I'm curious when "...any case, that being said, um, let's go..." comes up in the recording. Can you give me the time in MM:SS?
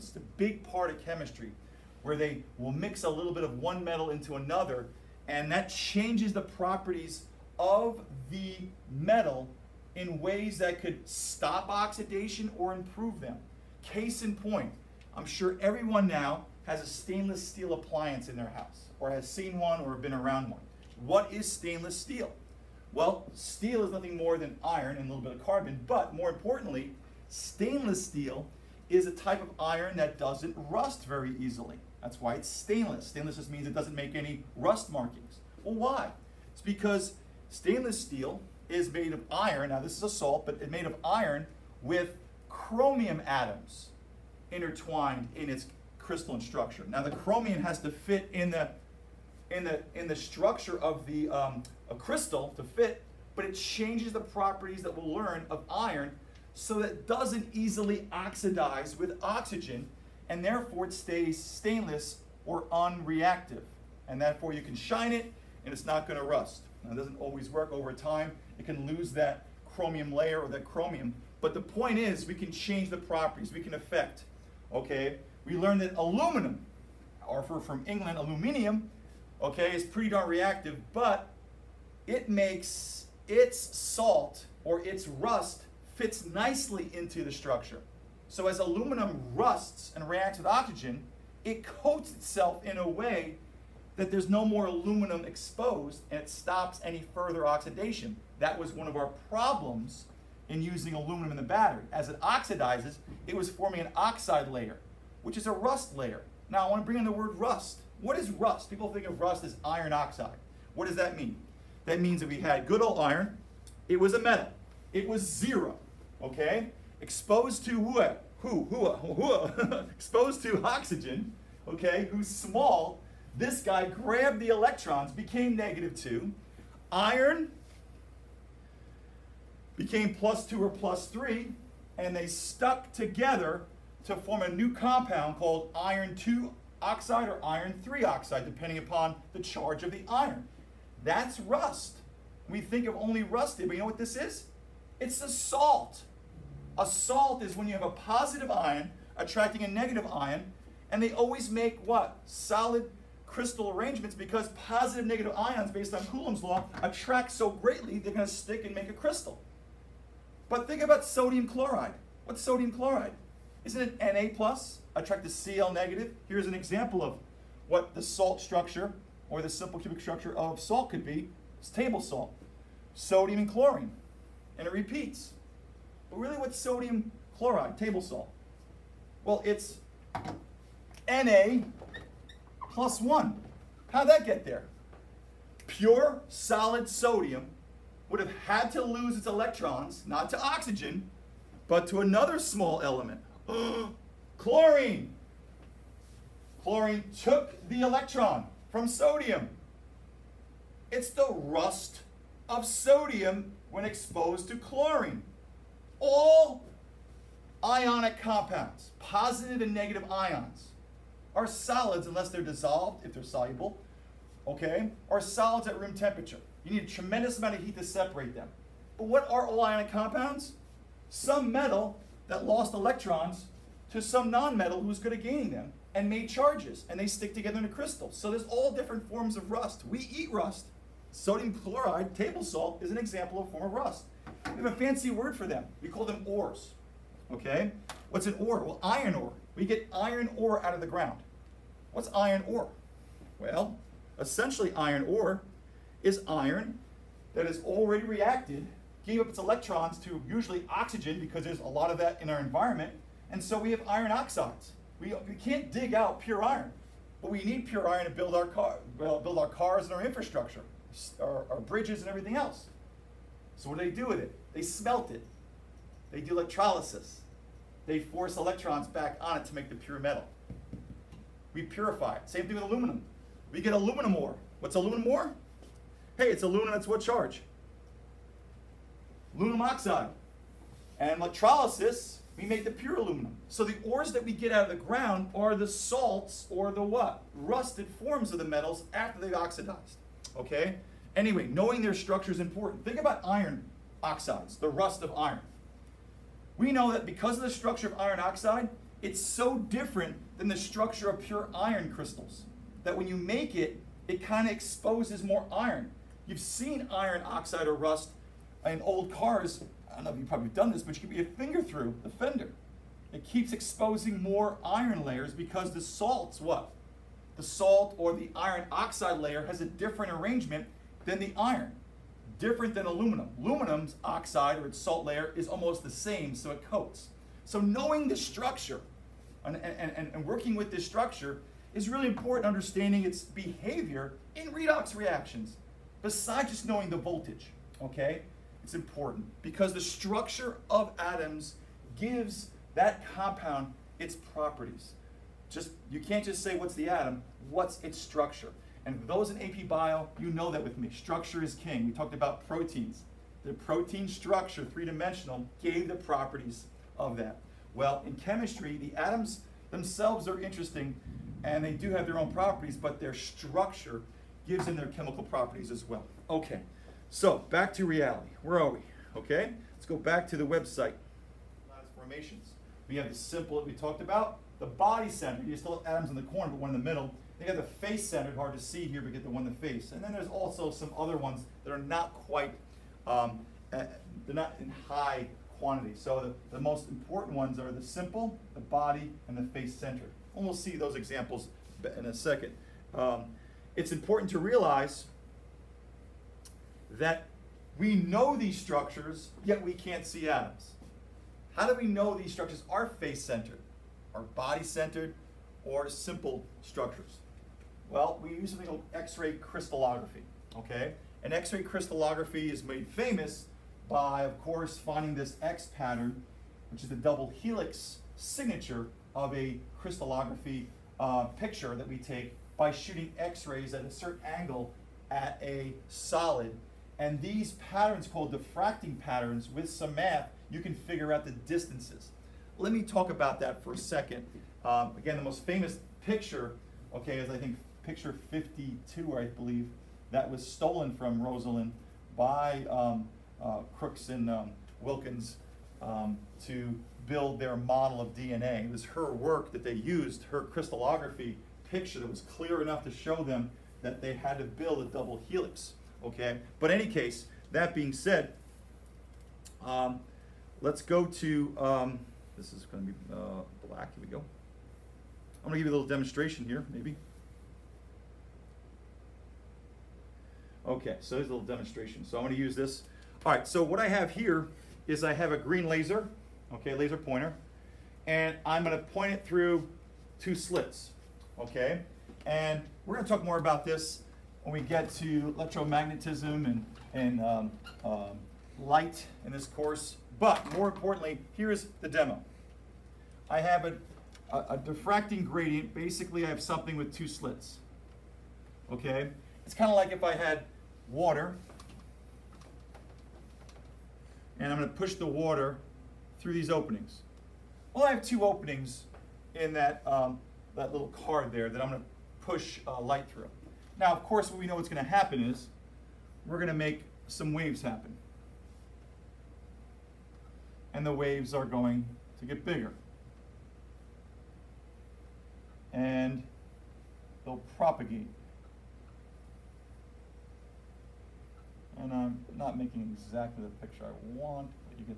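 07:36.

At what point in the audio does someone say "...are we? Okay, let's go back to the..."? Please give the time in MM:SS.
06:08.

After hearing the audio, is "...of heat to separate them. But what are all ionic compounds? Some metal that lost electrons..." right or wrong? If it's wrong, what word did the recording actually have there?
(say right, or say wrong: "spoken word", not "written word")
right.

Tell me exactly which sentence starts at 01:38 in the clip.
That was one of our problems in using aluminum in the battery.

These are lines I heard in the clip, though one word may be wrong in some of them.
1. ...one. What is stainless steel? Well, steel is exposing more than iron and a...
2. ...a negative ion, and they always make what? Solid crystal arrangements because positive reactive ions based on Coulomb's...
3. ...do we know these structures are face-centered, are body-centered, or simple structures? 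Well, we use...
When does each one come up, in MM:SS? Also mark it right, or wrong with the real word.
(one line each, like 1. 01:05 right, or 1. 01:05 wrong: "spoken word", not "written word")
1. 00:20 wrong: "nothing", not "exposing"
2. 02:29 wrong: "negative", not "reactive"
3. 06:41 right.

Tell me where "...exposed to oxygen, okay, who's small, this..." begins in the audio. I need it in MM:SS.
01:59.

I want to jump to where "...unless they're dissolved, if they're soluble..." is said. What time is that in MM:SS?
03:32.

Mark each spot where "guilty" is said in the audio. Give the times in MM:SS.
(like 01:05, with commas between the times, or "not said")
not said.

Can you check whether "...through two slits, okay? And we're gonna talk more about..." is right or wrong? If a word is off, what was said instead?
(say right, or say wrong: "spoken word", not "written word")
right.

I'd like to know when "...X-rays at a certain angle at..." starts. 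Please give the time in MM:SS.
07:03.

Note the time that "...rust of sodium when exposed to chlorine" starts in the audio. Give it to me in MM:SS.
03:21.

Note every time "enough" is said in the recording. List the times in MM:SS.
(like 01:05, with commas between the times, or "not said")
07:32.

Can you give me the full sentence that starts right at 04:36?
Hey, it's aluminum It's what charge?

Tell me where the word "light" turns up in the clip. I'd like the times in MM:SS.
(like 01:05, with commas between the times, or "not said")
08:08, 08:32.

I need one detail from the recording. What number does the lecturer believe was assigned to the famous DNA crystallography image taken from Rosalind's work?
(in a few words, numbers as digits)
52.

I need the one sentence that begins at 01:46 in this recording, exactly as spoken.
Now I want to bring in the word rust.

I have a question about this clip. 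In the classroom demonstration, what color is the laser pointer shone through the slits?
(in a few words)
green.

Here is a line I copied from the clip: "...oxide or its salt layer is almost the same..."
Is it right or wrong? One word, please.
right.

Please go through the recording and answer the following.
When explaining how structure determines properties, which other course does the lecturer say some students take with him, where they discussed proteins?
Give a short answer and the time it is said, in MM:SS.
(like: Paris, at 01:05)
AP Bio, at 05:49.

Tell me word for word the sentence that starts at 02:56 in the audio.
But really what's sodium chloride, table salt?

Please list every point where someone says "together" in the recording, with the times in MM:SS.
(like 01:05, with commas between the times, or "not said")
02:12, 03:47.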